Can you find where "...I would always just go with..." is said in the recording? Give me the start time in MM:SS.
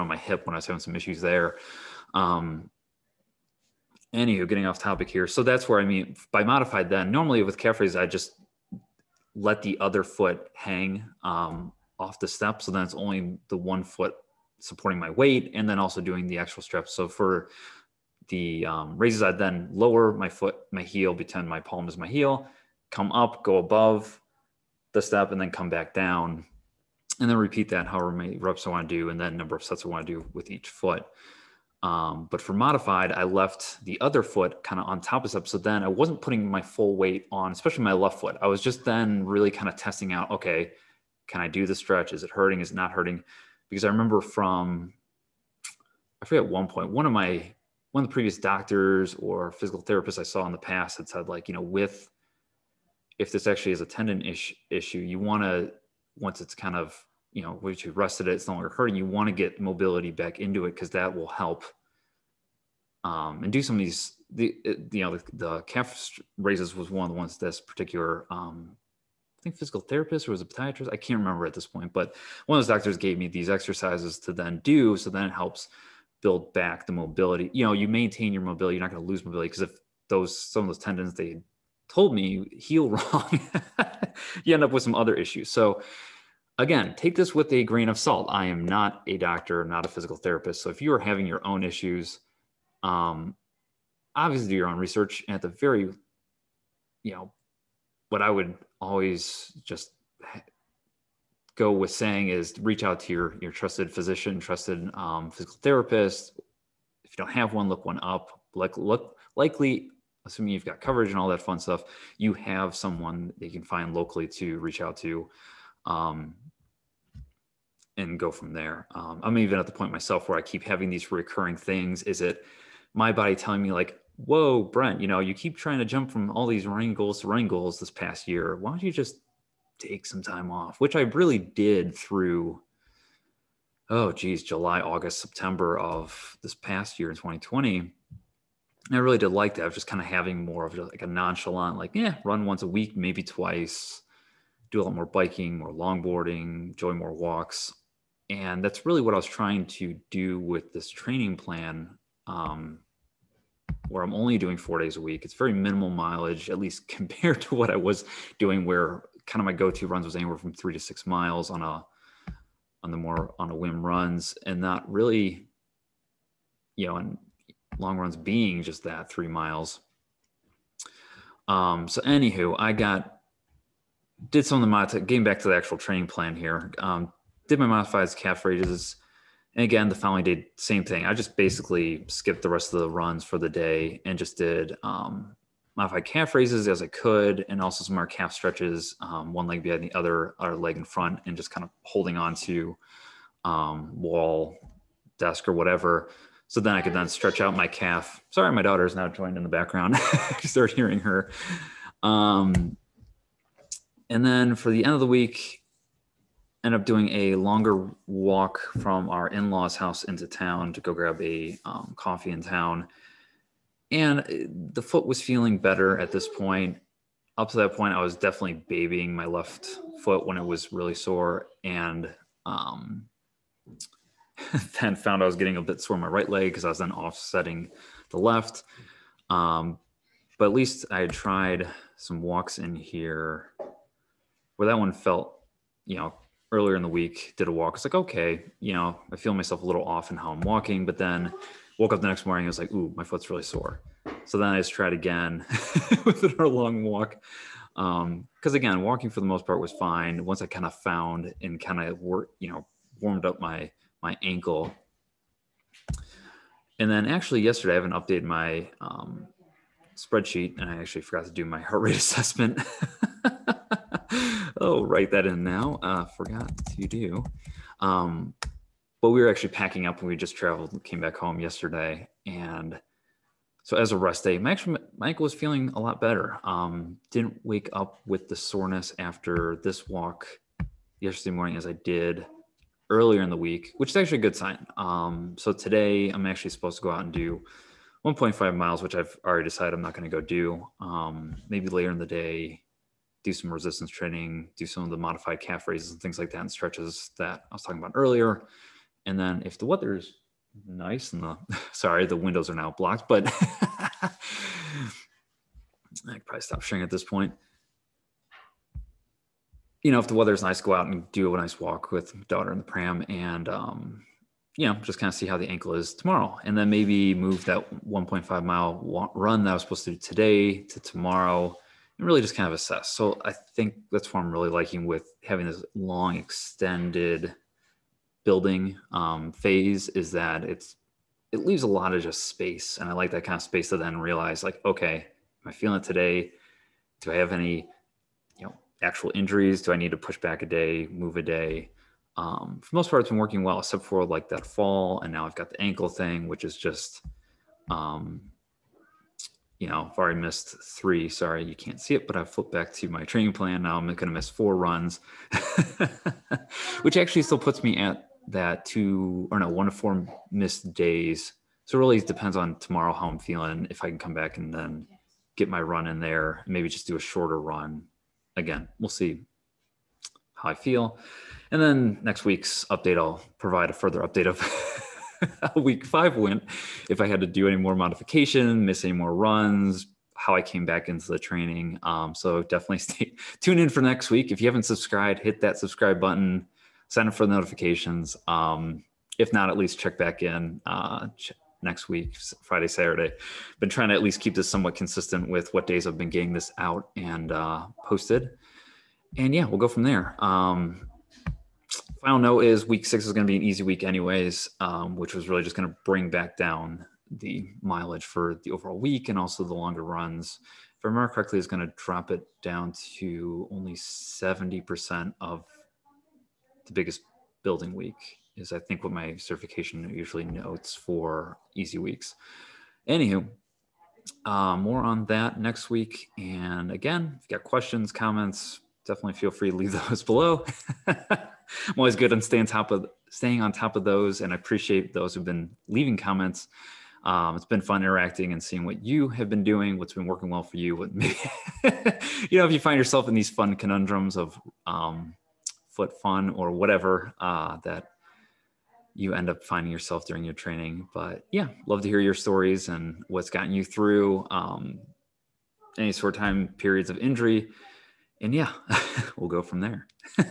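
01:38.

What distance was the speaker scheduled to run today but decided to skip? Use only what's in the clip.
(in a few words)
1.5 miles.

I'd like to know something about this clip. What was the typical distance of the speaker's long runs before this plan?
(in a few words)
3 miles.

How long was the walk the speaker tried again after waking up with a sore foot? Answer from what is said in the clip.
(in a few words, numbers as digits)
an hour.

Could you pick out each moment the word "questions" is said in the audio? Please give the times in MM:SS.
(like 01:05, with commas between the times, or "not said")
07:07.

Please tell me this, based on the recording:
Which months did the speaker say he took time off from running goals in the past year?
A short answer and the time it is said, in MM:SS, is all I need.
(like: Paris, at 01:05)
July, August, September, at 02:14.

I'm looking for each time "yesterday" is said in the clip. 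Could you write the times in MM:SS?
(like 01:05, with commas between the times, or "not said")
04:17, 04:31, 04:40.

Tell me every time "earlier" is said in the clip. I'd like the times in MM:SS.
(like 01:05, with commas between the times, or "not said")
03:56, 04:42, 04:57.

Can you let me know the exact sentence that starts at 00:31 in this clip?
Um, but for modified, I left the other foot kind of on top of step.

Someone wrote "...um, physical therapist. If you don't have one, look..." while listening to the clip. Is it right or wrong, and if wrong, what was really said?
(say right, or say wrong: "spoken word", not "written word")
right.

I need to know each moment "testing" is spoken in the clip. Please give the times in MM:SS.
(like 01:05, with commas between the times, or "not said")
00:39.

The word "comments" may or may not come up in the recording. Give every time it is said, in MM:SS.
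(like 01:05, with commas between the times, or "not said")
07:07, 07:15.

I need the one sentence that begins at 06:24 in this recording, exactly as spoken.
If you haven't subscribed, hit that subscribe button, sign up for the notifications.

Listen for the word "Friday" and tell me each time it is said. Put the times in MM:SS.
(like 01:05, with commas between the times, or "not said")
06:32.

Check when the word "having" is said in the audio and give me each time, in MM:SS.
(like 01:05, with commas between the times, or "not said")
00:00, 01:30, 02:00, 02:20, 05:25.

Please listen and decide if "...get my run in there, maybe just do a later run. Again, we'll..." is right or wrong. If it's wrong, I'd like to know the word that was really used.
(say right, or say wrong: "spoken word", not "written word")
wrong: "shorter", not "later".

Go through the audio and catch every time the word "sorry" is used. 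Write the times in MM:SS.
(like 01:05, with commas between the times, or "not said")
03:18, 05:01, 05:51.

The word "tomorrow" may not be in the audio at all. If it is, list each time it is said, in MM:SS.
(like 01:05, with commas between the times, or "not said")
05:15, 05:20, 06:02.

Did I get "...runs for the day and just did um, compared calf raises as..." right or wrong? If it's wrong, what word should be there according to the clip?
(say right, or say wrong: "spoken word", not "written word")
wrong: "modified", not "compared".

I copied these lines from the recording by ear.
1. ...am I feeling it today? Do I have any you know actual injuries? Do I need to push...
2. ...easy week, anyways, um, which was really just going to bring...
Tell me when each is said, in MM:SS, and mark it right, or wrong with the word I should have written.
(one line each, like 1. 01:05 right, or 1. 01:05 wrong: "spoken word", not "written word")
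1. 05:34 right
2. 06:43 right.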